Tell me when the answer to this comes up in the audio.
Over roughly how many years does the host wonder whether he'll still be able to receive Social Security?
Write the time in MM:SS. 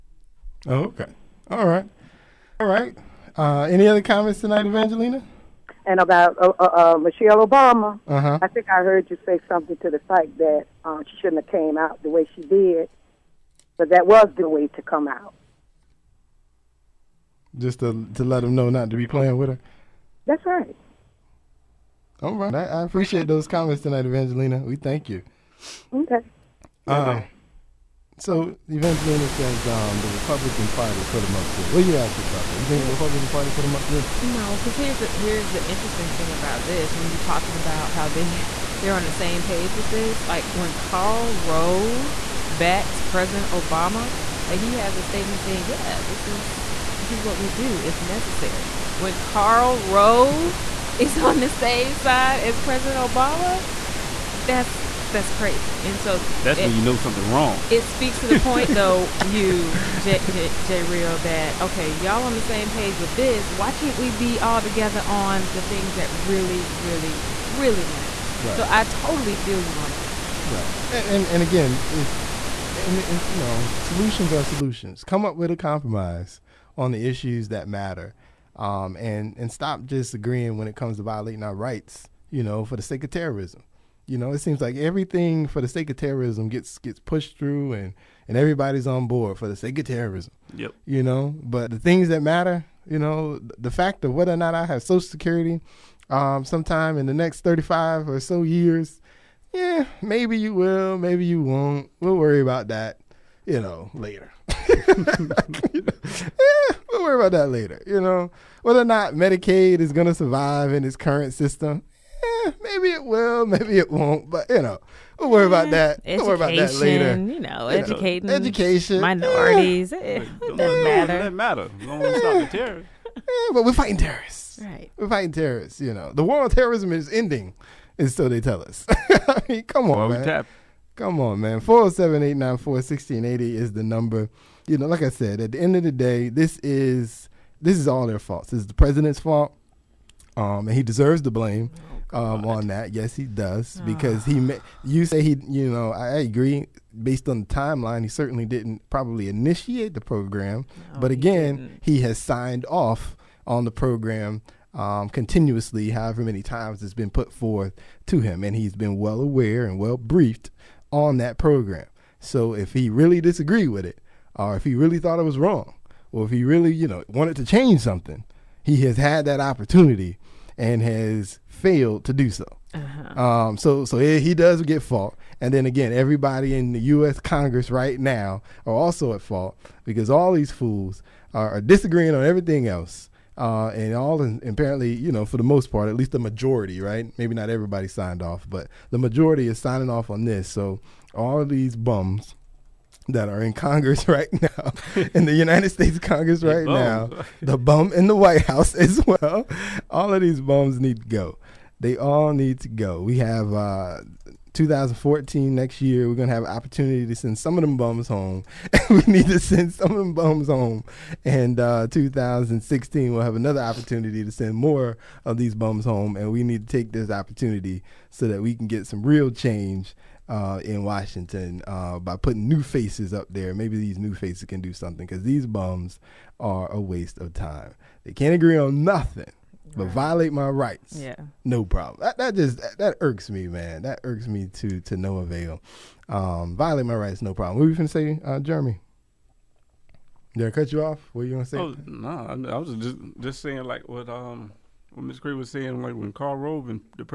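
01:37.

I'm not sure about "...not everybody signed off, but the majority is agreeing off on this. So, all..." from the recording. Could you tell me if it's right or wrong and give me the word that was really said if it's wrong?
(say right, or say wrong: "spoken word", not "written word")
wrong: "signing", not "agreeing".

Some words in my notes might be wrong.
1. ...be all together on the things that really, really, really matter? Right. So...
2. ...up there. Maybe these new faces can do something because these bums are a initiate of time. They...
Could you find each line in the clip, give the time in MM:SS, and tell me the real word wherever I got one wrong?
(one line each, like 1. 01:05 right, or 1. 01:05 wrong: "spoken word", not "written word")
1. 01:04 right
2. 03:43 wrong: "waste", not "initiate".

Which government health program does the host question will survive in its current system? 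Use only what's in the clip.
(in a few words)
Medicaid.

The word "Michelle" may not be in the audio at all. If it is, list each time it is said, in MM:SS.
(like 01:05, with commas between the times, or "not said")
00:06.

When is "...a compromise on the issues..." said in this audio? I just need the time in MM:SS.
01:15.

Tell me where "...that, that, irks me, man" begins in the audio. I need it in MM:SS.
03:52.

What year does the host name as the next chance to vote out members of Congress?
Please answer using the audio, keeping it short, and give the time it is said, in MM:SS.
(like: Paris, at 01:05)
2014, at 03:24.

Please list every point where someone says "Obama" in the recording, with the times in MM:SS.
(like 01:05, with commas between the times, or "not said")
00:07, 00:43, 00:52.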